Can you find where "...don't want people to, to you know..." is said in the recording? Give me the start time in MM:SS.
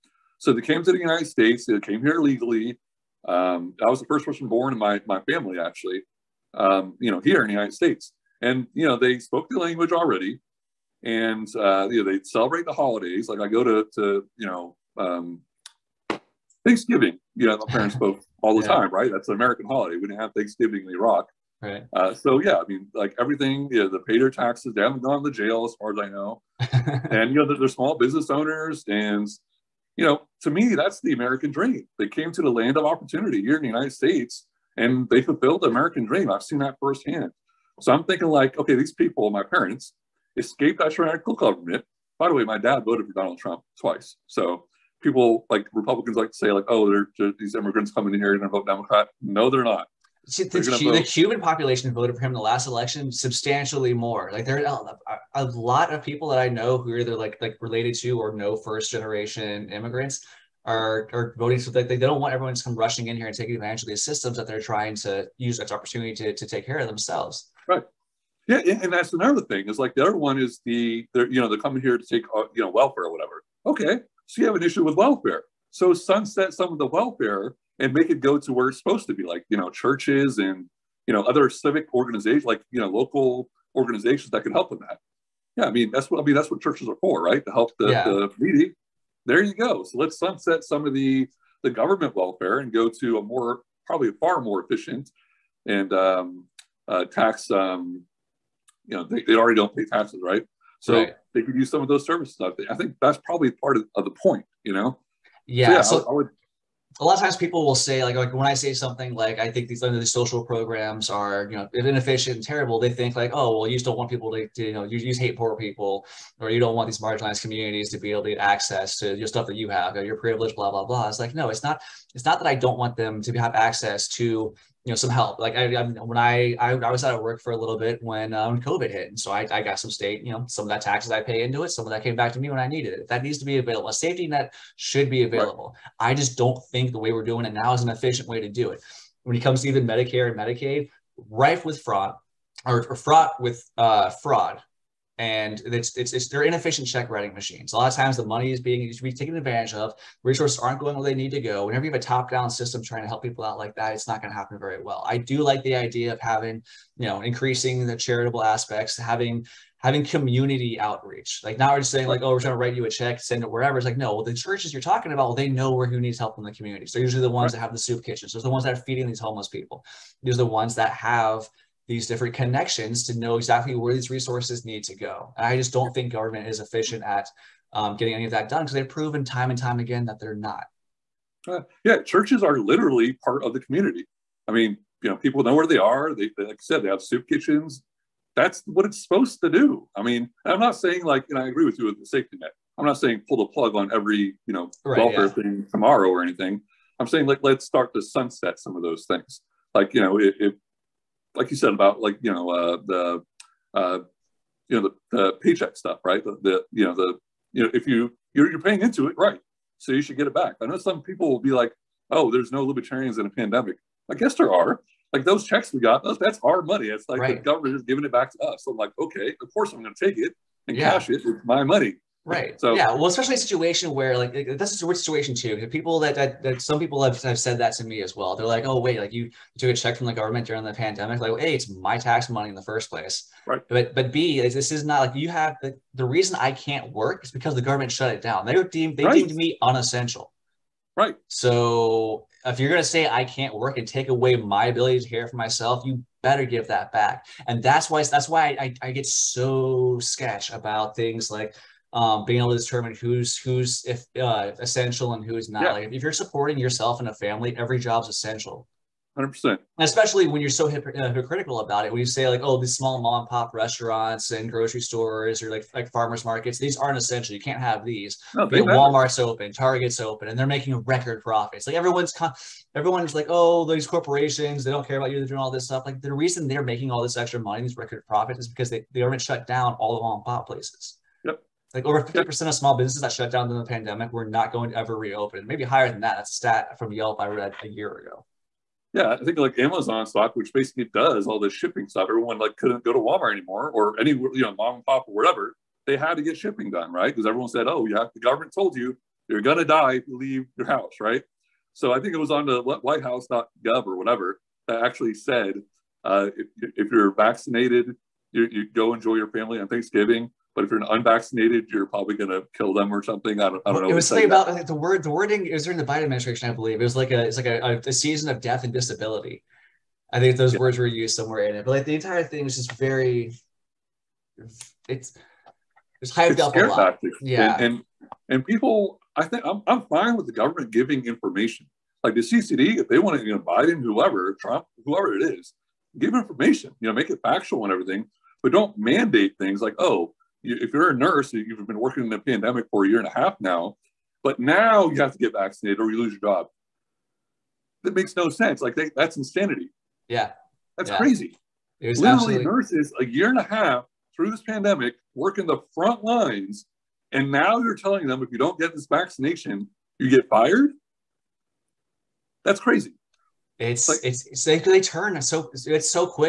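01:53.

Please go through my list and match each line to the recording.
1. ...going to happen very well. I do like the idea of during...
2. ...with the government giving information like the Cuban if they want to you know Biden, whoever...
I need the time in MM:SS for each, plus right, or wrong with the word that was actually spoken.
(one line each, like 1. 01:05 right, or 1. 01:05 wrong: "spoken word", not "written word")
1. 02:34 wrong: "having", not "during"
2. 05:30 wrong: "CCD", not "Cuban".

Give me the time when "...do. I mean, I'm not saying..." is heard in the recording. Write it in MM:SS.
03:09.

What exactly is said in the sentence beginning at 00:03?
Um, I was the first person born in my, my family, actually, um, you know, here in the United States.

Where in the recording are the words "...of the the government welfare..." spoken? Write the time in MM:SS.
01:30.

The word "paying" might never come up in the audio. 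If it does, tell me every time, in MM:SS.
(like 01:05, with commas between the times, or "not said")
03:28.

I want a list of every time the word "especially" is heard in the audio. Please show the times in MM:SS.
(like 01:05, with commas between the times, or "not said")
03:43, 04:19.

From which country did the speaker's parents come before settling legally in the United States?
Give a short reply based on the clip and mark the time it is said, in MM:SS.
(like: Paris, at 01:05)
Iraq, at 00:20.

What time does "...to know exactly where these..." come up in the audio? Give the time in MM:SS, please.
02:53.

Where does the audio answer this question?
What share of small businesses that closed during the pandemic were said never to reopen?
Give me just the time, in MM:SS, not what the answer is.
04:41.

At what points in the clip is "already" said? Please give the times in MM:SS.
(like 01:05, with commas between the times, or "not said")
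00:09, 01:39.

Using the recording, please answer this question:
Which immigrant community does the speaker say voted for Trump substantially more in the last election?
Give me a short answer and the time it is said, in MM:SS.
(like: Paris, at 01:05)
Cuban, at 00:51.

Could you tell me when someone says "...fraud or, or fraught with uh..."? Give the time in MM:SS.
02:21.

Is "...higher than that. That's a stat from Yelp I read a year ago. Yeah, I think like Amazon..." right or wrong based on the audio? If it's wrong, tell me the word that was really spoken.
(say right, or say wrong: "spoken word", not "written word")
right.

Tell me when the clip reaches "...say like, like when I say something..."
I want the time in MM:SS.
01:47.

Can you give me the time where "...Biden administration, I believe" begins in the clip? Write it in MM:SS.
05:15.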